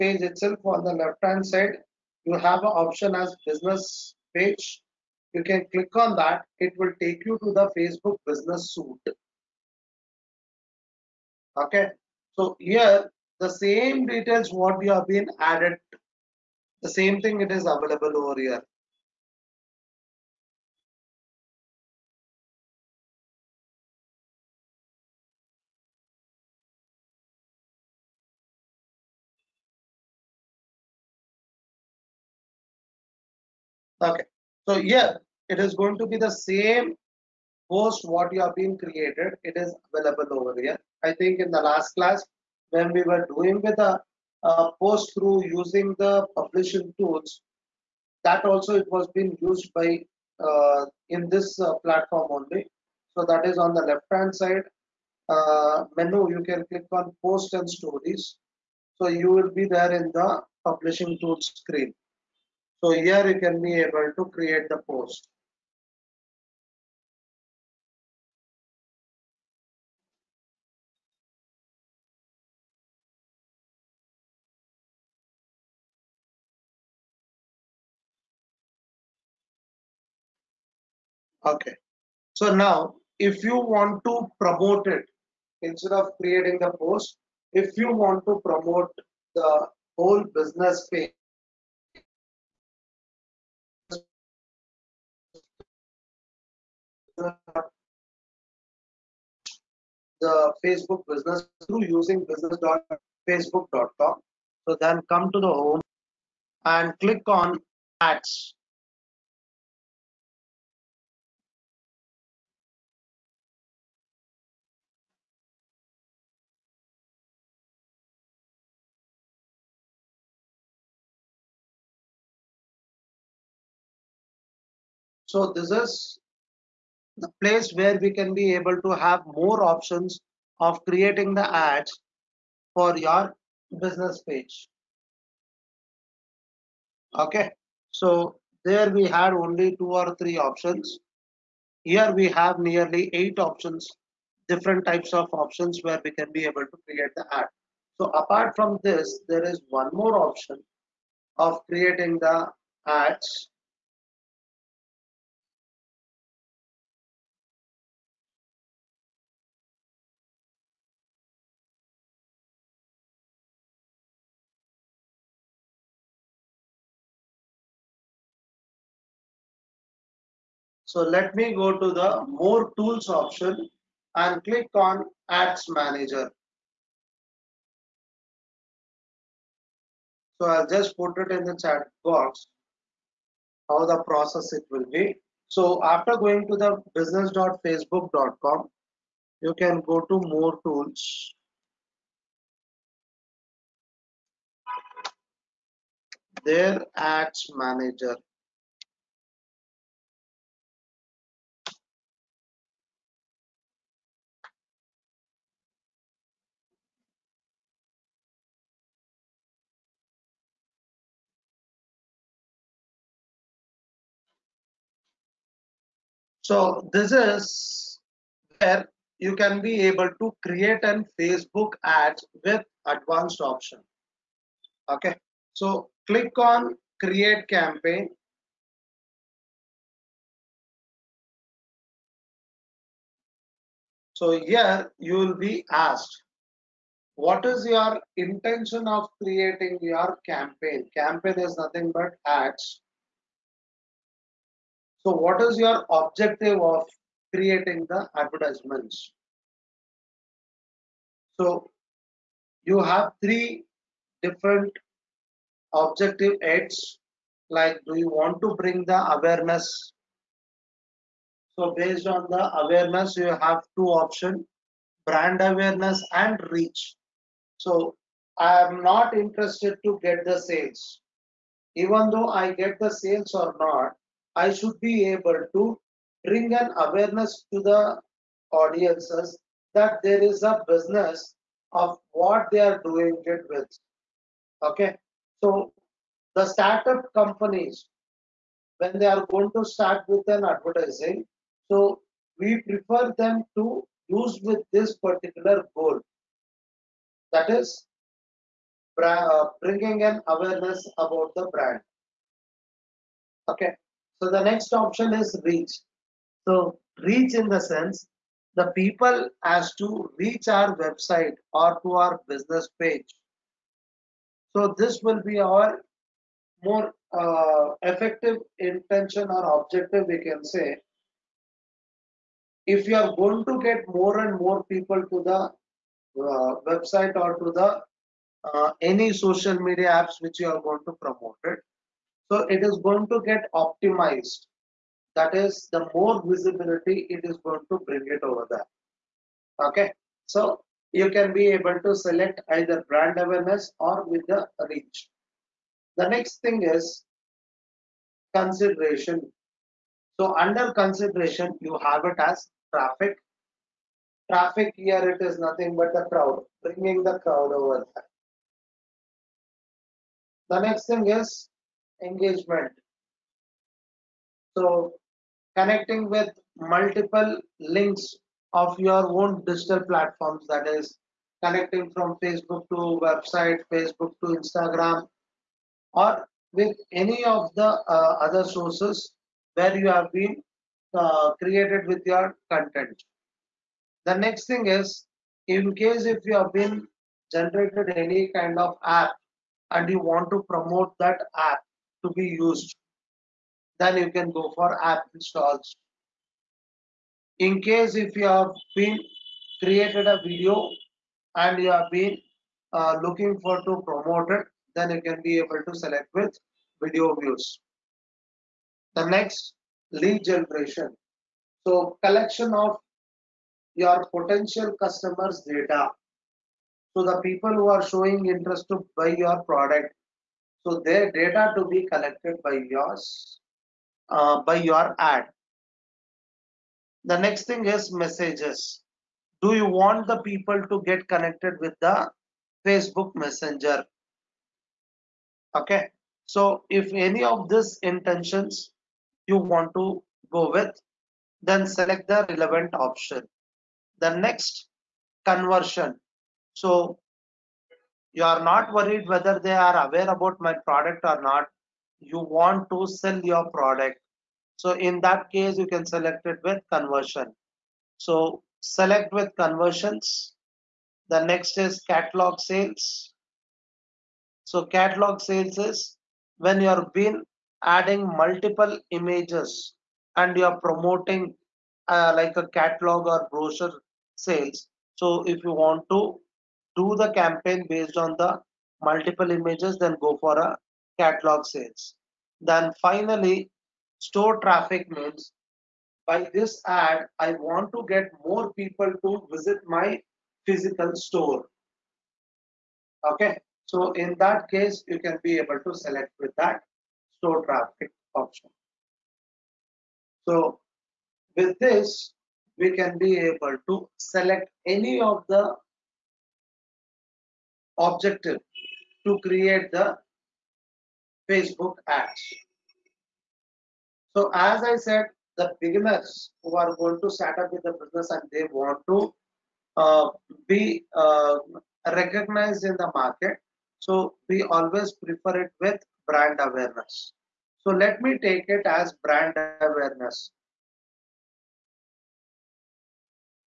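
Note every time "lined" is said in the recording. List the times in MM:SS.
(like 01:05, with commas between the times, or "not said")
not said.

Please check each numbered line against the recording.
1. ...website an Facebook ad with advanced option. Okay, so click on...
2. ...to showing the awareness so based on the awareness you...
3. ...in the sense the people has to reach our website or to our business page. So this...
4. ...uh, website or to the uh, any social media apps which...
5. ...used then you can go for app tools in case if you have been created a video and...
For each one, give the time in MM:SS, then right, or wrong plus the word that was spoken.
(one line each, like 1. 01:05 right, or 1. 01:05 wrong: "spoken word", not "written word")
1. 03:40 wrong: "create", not "website"
2. 04:18 wrong: "bring", not "showing"
3. 05:07 right
4. 05:25 right
5. 06:32 wrong: "installs", not "tools".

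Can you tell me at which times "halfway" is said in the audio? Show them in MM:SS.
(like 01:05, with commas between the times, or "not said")
not said.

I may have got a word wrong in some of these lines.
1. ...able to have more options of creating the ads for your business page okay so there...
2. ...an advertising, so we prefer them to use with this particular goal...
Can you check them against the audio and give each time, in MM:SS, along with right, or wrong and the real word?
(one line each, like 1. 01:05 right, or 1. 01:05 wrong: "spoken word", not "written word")
1. 02:08 right
2. 04:50 right.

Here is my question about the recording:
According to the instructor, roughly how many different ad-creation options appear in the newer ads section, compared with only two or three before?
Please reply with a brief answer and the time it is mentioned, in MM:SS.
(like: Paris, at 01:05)
8, at 02:23.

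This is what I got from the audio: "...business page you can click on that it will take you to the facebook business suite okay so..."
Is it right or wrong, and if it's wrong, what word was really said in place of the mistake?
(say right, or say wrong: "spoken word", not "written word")
right.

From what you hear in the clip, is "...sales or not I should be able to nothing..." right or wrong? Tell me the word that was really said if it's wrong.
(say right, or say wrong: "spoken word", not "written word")
wrong: "bring", not "nothing".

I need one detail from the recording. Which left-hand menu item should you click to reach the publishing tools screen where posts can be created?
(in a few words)
Post and stories.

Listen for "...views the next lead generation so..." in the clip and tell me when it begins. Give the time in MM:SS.
06:47.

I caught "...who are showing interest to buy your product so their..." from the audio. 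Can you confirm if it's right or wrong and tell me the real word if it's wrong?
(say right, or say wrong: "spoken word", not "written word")
right.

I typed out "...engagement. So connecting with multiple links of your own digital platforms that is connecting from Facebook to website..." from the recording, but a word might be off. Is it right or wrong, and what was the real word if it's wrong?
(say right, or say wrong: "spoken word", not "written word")
right.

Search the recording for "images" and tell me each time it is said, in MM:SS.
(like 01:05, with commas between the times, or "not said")
07:48, 07:59.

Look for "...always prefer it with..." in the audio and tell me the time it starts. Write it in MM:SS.
08:44.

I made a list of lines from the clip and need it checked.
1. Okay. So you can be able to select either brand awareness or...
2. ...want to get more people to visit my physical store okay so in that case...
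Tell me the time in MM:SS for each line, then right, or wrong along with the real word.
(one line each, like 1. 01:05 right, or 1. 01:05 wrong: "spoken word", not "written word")
1. 05:39 right
2. 08:07 right.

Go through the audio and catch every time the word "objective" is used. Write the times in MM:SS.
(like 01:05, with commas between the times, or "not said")
04:05, 04:15, 05:19, 08:27.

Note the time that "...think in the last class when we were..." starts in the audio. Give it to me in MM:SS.
00:41.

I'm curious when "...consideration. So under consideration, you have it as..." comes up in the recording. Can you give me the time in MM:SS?
05:48.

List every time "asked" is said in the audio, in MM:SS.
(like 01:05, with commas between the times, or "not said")
03:55.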